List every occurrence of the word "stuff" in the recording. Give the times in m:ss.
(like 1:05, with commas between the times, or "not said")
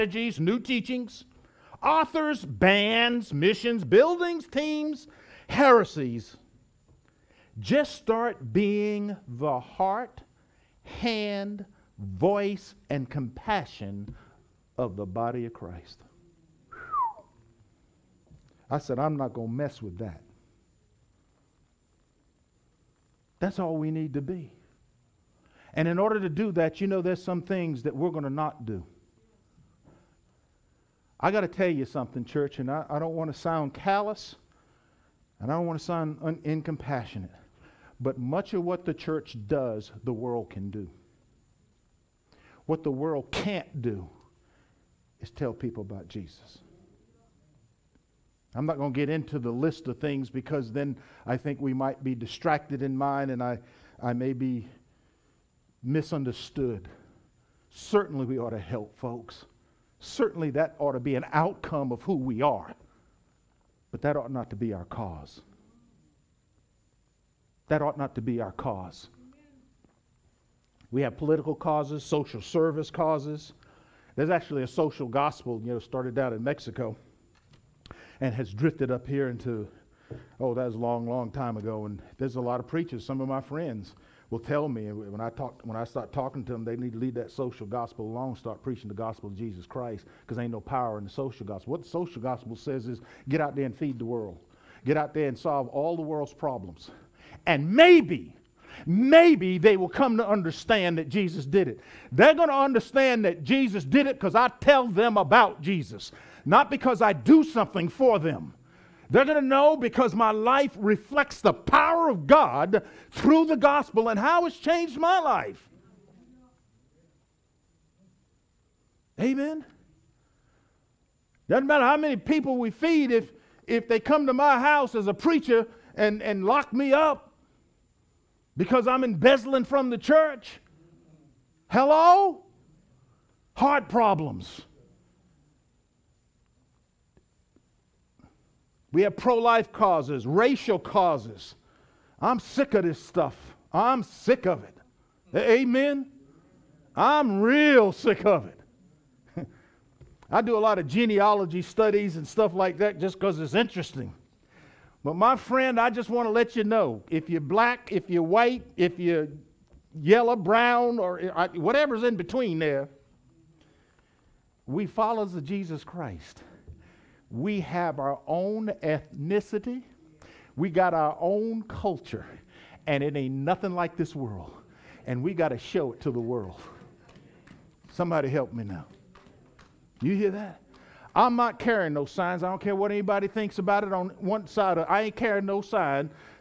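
2:23, 2:32.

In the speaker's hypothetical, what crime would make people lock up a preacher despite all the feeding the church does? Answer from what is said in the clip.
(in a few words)
Embezzling from the church.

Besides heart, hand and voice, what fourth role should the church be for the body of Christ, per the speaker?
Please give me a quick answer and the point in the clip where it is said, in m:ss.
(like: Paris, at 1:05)
Compassion, at 0:13.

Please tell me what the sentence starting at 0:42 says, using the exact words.
What the world can't do is tell people about Jesus.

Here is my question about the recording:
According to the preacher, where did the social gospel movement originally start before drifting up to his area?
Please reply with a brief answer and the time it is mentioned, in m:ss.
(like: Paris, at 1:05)
Mexico, at 1:16.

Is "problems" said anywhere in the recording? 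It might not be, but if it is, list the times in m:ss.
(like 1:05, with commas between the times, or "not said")
1:36, 2:13.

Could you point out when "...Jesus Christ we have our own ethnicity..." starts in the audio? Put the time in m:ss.
2:45.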